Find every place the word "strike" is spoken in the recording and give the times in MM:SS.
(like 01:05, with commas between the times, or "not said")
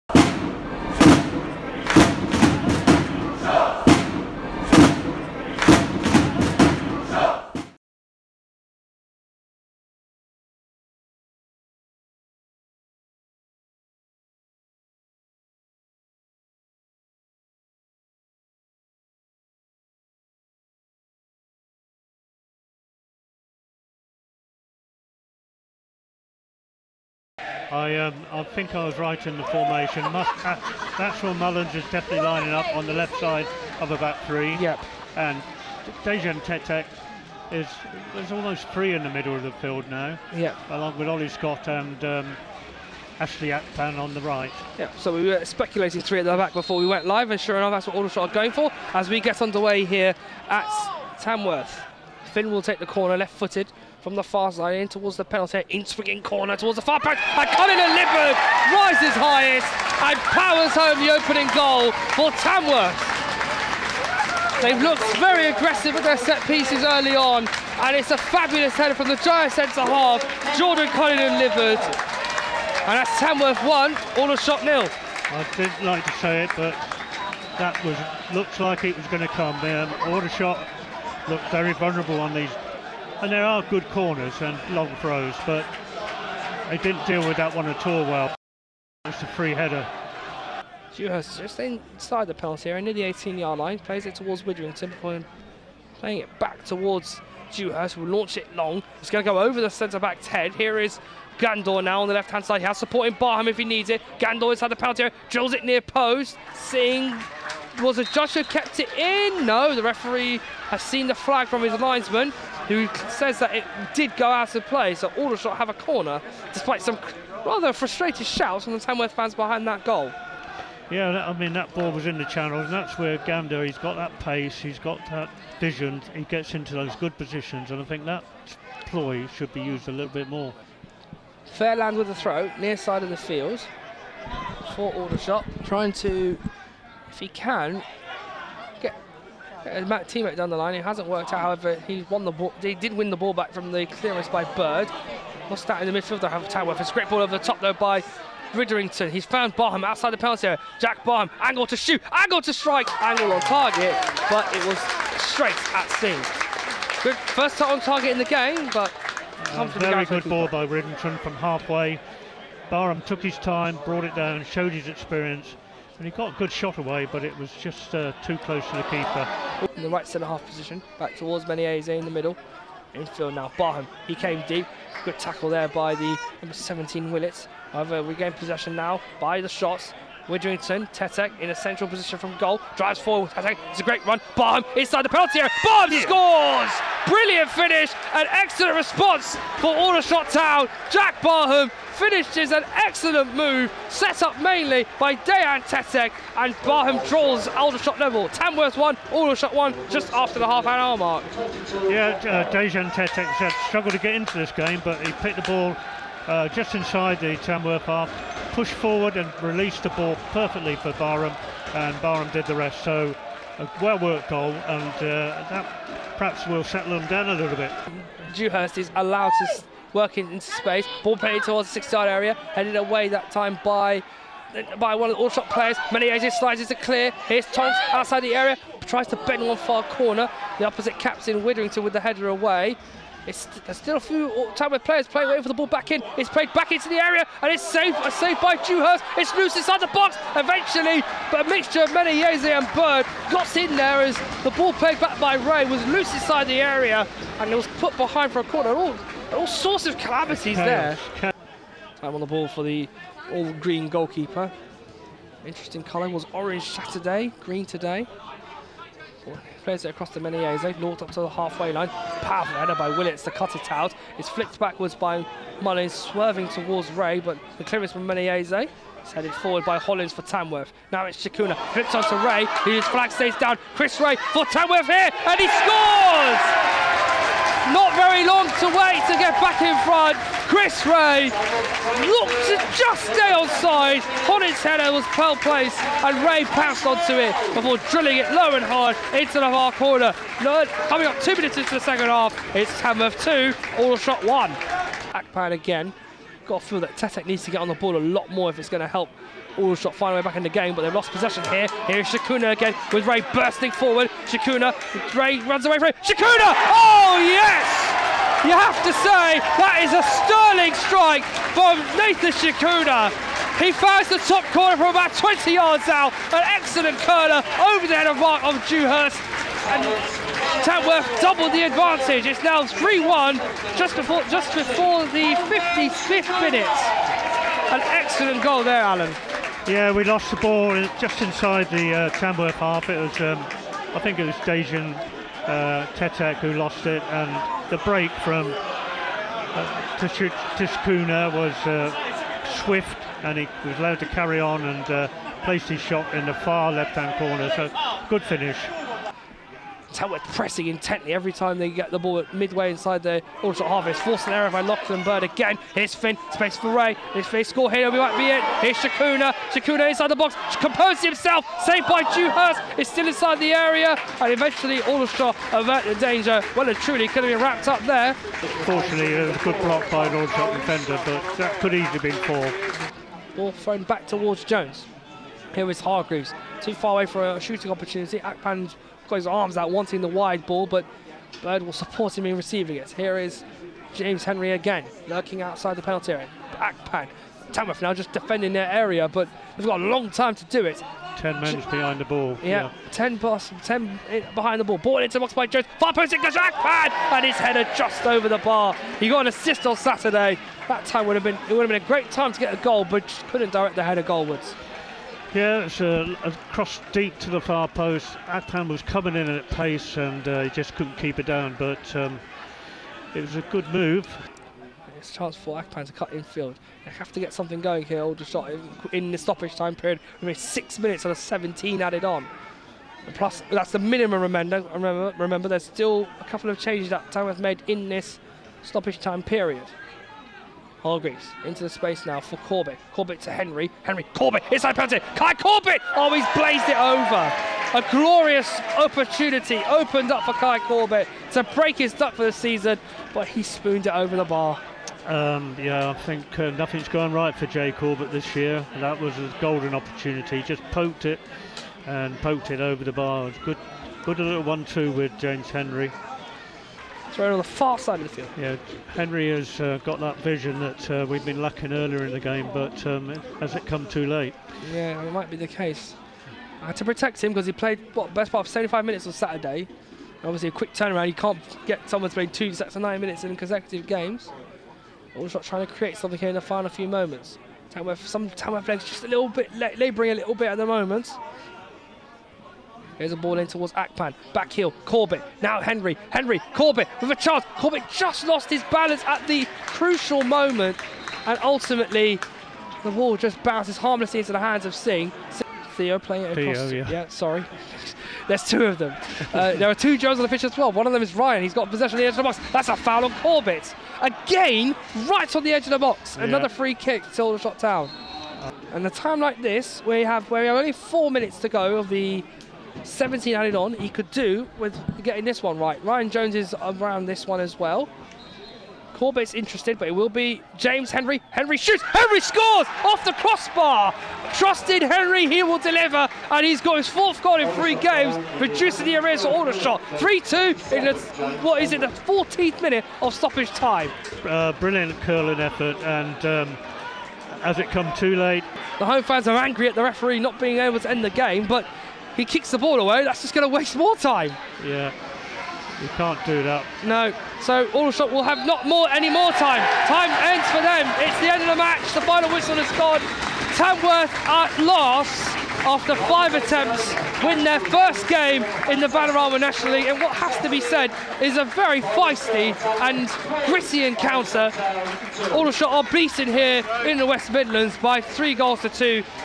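02:32, 05:10.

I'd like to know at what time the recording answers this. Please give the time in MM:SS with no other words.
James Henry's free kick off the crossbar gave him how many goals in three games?
08:46.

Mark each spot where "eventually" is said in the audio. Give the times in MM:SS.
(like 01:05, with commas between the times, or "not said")
04:00, 06:04.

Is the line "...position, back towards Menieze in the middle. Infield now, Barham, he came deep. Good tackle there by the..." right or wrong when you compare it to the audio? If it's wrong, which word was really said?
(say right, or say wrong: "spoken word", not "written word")
right.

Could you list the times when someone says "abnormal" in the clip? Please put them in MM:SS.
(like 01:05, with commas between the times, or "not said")
not said.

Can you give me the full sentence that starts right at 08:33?
He could do with getting this one right.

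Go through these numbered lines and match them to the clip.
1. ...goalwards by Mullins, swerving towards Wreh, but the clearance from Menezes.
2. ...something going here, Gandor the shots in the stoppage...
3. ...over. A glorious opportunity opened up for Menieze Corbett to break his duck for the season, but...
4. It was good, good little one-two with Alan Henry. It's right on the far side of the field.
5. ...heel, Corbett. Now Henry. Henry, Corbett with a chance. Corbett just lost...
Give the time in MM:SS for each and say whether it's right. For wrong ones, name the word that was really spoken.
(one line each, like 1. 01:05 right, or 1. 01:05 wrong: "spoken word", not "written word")
1. 04:24 wrong: "backwards", not "goalwards"
2. 06:57 wrong: "All", not "Gandor"
3. 07:16 wrong: "Kai", not "Menieze"
4. 07:33 wrong: "James", not "Alan"
5. 08:04 right.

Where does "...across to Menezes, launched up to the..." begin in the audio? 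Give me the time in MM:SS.
04:19.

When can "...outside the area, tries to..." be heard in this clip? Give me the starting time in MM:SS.
03:47.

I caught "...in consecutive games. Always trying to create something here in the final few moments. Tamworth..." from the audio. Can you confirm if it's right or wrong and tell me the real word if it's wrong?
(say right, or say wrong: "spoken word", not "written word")
right.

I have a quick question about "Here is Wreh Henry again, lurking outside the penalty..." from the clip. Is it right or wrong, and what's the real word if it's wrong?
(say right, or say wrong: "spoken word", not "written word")
wrong: "James", not "Wreh".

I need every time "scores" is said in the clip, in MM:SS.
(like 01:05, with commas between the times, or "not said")
03:06, 04:35, 05:57, 08:42.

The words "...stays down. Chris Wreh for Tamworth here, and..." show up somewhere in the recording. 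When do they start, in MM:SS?
04:33.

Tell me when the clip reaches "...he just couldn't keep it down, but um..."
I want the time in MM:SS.
06:50.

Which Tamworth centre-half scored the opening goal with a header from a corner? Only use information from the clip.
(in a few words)
Jordan Collin and Livers.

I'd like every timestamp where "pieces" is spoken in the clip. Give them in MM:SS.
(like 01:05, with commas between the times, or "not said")
01:06.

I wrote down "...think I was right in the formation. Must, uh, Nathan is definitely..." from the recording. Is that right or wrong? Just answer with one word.
wrong.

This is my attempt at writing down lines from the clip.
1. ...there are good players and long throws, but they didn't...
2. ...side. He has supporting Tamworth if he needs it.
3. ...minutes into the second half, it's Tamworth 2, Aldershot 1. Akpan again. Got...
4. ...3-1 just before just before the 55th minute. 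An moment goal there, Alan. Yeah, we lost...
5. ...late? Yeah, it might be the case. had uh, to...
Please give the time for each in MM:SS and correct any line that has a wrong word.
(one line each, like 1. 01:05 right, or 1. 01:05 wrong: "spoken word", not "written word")
1. 01:23 wrong: "corners", not "players"
2. 01:42 wrong: "Barham", not "Tamworth"
3. 04:51 right
4. 05:22 wrong: "excellent", not "moment"
5. 07:44 right.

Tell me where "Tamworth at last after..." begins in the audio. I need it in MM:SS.
09:13.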